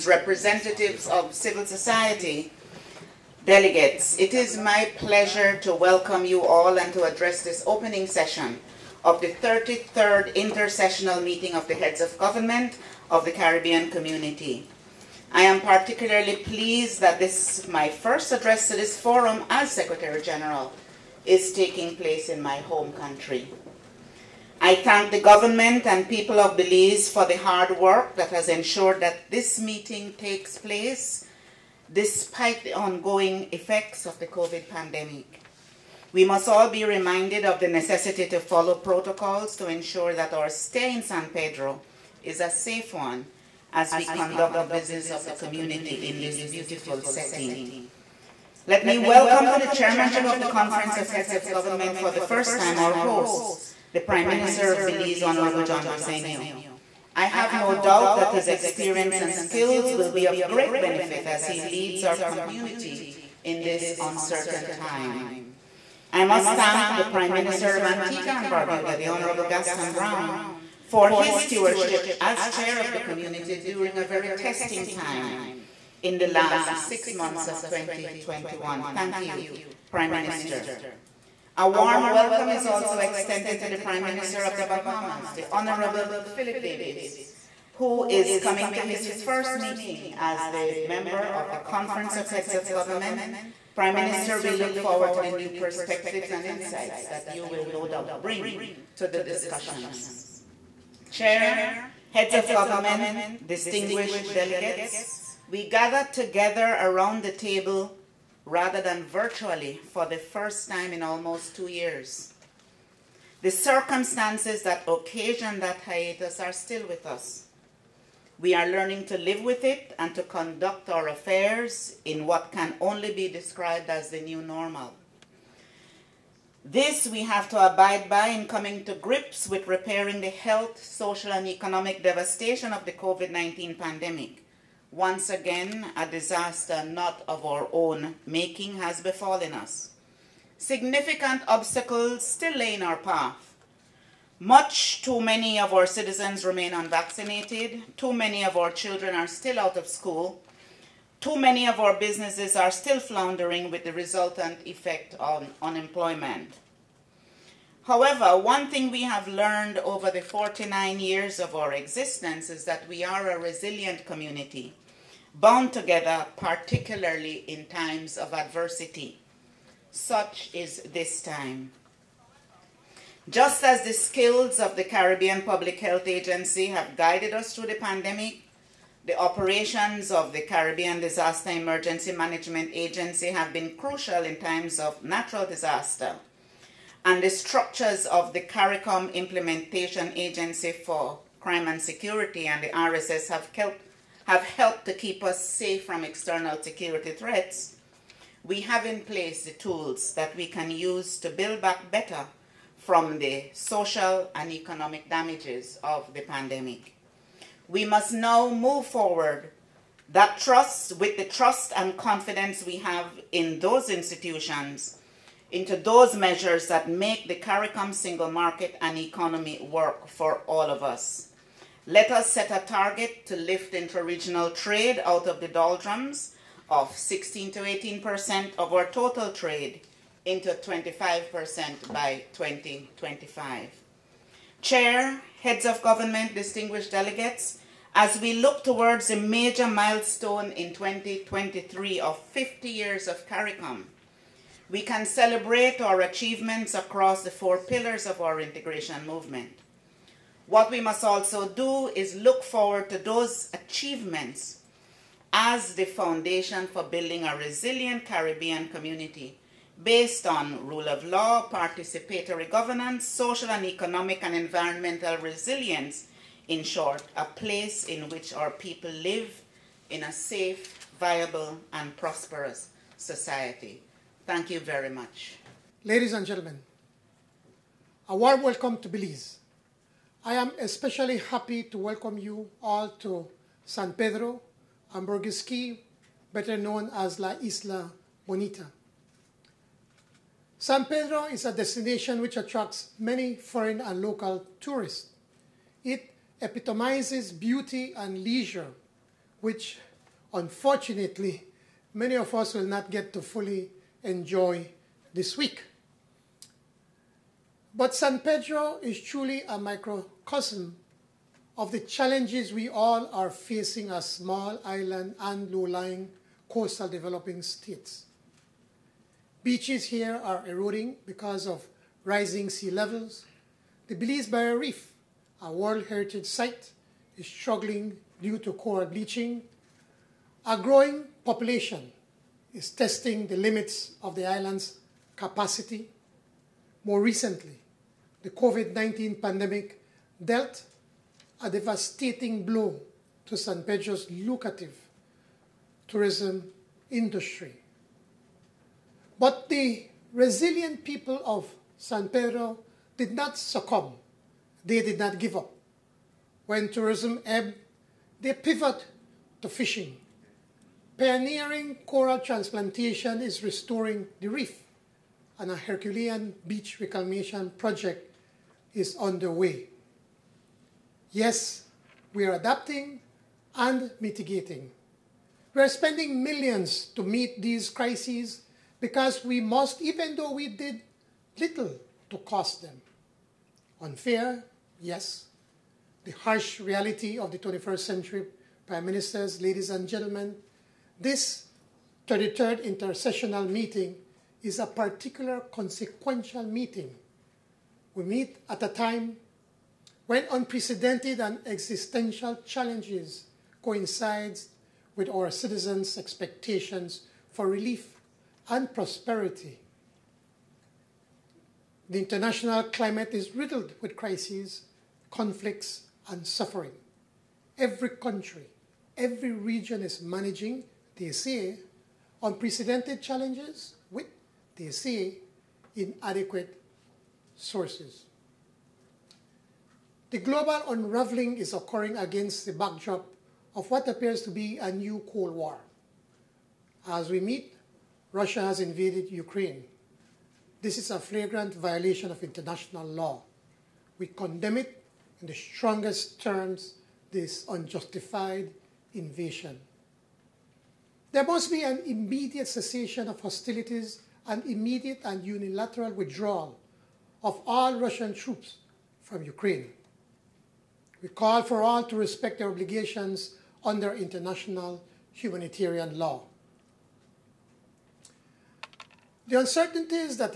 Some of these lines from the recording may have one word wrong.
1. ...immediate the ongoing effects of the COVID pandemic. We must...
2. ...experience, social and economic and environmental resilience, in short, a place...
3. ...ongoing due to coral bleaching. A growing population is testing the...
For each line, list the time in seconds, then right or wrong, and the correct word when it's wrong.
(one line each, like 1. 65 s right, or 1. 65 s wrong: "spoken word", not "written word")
1. 31 s wrong: "despite", not "immediate"
2. 262 s wrong: "governance", not "experience"
3. 327 s wrong: "struggling", not "ongoing".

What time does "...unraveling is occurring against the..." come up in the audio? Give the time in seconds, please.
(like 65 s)
430 s.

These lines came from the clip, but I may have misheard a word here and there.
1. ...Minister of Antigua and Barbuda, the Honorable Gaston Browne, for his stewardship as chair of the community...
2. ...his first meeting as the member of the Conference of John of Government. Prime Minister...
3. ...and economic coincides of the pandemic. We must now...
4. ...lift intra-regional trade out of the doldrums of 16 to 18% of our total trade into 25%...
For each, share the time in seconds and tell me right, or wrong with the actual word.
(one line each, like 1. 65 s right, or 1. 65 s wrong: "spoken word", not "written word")
1. 67 s right
2. 88 s wrong: "Heads", not "John"
3. 204 s wrong: "damages", not "coincides"
4. 223 s right.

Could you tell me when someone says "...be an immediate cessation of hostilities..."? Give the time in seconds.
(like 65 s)
451 s.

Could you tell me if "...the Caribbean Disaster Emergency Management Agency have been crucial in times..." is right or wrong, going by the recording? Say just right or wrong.
right.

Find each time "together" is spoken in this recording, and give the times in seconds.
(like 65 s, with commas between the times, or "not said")
106 s, 165 s.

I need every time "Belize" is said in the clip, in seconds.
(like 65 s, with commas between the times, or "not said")
26 s, 54 s, 278 s, 323 s.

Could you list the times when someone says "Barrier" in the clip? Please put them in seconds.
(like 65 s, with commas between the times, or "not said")
324 s.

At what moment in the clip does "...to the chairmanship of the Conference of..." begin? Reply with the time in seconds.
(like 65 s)
49 s.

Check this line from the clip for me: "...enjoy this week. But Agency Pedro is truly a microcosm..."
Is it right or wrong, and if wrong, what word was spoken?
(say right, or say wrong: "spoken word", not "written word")
wrong: "San", not "Agency".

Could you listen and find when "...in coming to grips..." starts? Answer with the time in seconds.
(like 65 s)
128 s.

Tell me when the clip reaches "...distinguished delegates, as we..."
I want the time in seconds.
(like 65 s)
236 s.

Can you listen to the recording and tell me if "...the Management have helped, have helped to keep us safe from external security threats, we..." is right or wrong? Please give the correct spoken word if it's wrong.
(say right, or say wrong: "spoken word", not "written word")
wrong: "RSS", not "Management".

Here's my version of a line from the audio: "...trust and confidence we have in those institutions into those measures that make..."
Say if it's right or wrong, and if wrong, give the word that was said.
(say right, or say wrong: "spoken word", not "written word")
right.